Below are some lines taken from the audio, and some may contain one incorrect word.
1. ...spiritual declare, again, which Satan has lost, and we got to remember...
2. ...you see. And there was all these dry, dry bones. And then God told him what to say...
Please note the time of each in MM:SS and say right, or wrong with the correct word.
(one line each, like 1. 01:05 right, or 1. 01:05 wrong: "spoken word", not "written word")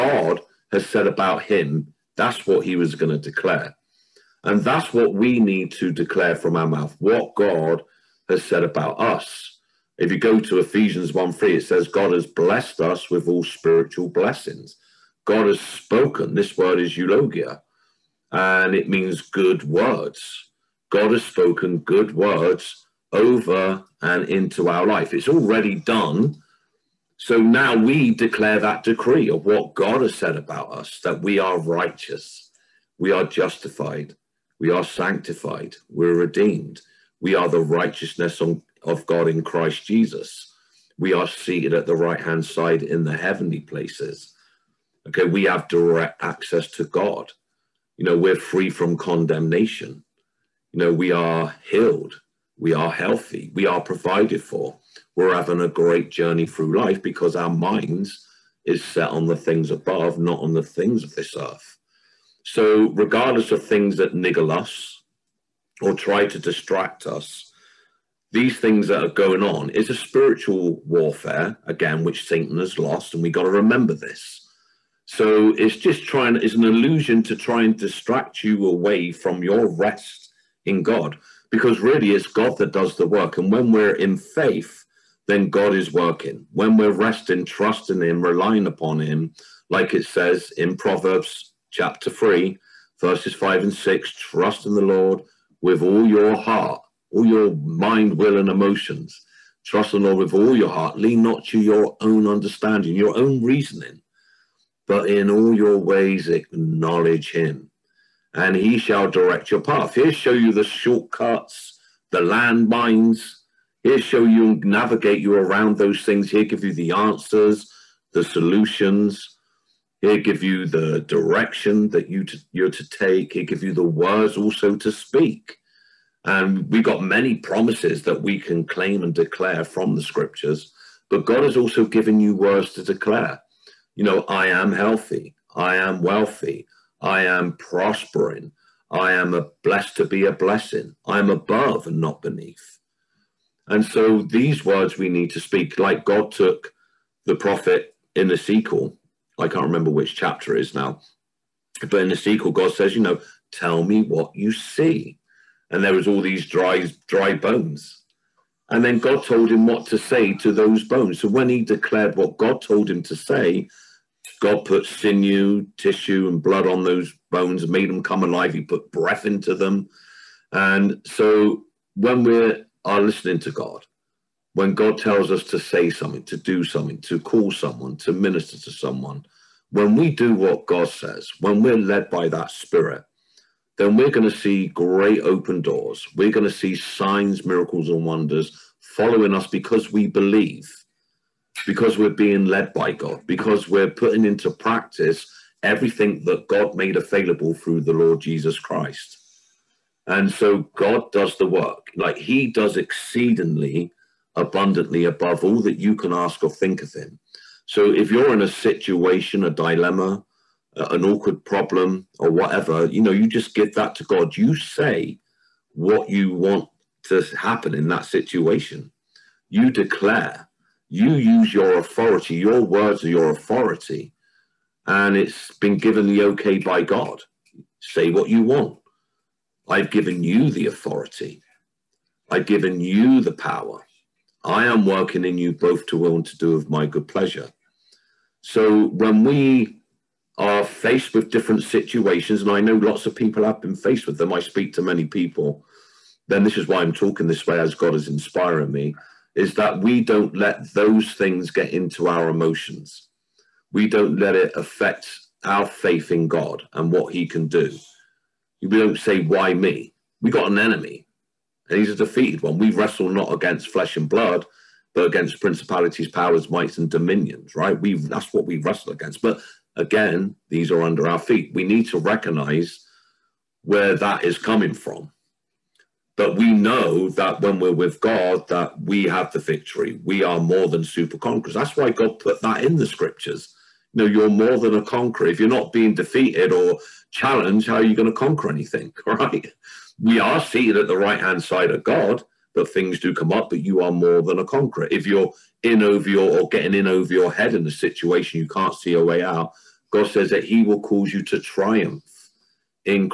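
1. 01:09 wrong: "warfare", not "declare"
2. 02:34 right.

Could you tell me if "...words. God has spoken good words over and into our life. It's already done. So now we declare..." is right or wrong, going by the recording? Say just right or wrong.
right.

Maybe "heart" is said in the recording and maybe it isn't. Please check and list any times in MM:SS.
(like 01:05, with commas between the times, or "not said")
01:36, 01:40.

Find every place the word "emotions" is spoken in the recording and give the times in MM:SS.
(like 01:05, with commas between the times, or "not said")
01:38, 04:12.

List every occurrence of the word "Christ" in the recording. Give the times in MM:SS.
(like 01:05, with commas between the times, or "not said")
00:39, 03:18.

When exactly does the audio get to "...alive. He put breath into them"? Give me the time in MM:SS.
02:48.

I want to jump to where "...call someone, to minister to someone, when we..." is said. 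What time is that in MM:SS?
02:57.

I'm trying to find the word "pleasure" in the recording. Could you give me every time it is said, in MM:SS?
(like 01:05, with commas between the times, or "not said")
03:57.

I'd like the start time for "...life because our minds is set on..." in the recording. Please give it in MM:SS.
00:56.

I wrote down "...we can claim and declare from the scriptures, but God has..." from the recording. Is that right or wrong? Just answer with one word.
right.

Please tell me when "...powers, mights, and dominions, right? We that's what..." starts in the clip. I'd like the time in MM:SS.
04:26.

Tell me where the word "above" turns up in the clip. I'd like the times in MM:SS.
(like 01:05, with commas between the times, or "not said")
00:59, 02:21, 03:25.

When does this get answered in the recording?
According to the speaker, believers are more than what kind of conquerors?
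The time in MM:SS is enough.
04:40.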